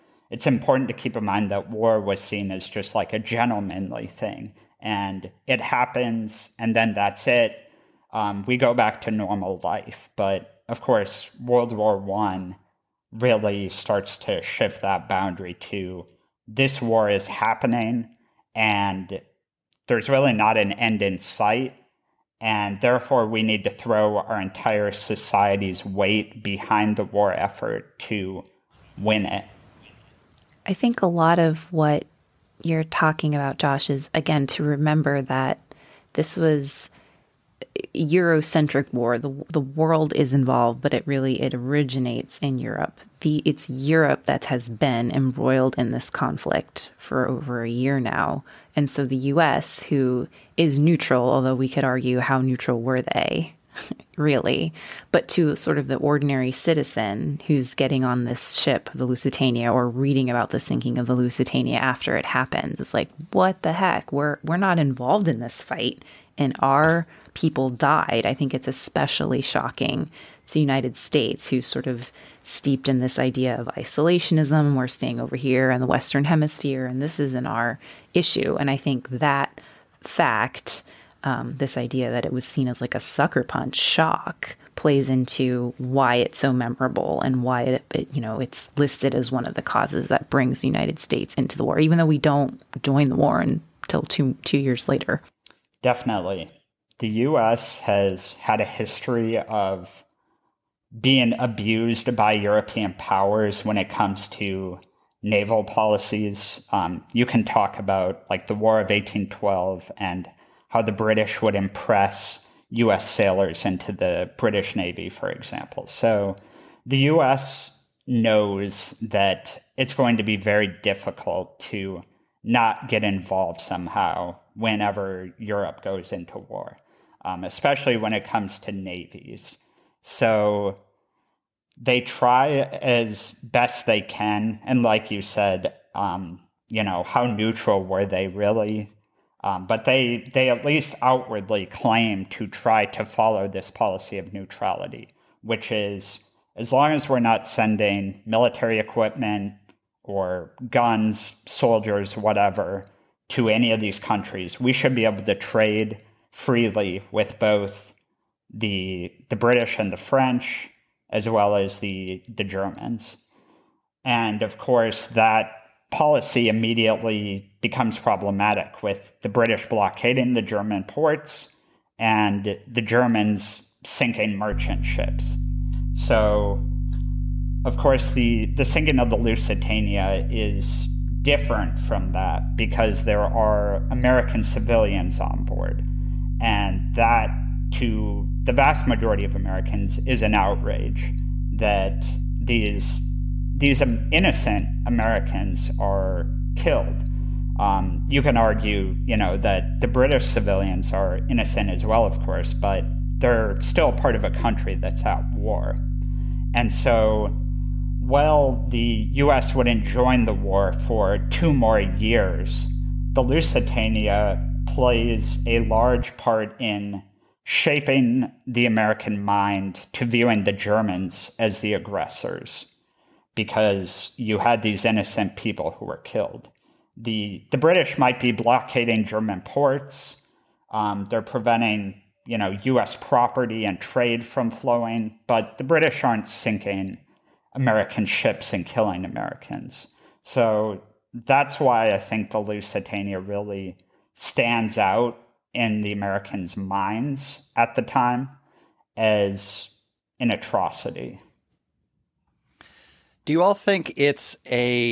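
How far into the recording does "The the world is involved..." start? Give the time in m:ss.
0:39.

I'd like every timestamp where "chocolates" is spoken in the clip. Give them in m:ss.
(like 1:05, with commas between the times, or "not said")
not said.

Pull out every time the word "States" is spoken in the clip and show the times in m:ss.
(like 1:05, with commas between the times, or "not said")
1:10, 1:30.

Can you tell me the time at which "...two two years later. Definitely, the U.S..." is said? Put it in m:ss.
1:34.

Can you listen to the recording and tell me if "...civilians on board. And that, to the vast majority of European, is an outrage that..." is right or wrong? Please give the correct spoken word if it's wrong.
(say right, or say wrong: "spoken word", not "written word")
wrong: "Americans", not "European".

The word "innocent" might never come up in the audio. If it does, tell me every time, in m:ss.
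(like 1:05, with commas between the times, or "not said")
3:14, 3:21, 3:44.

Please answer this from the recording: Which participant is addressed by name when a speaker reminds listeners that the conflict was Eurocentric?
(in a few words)
Josh.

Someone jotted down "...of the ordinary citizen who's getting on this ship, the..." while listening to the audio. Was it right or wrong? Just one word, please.
right.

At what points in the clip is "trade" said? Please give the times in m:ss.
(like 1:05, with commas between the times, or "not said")
2:35, 3:53.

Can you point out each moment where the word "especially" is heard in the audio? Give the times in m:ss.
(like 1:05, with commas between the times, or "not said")
1:08, 2:07.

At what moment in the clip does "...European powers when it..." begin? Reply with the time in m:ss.
1:42.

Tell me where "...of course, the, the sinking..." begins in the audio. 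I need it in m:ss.
2:57.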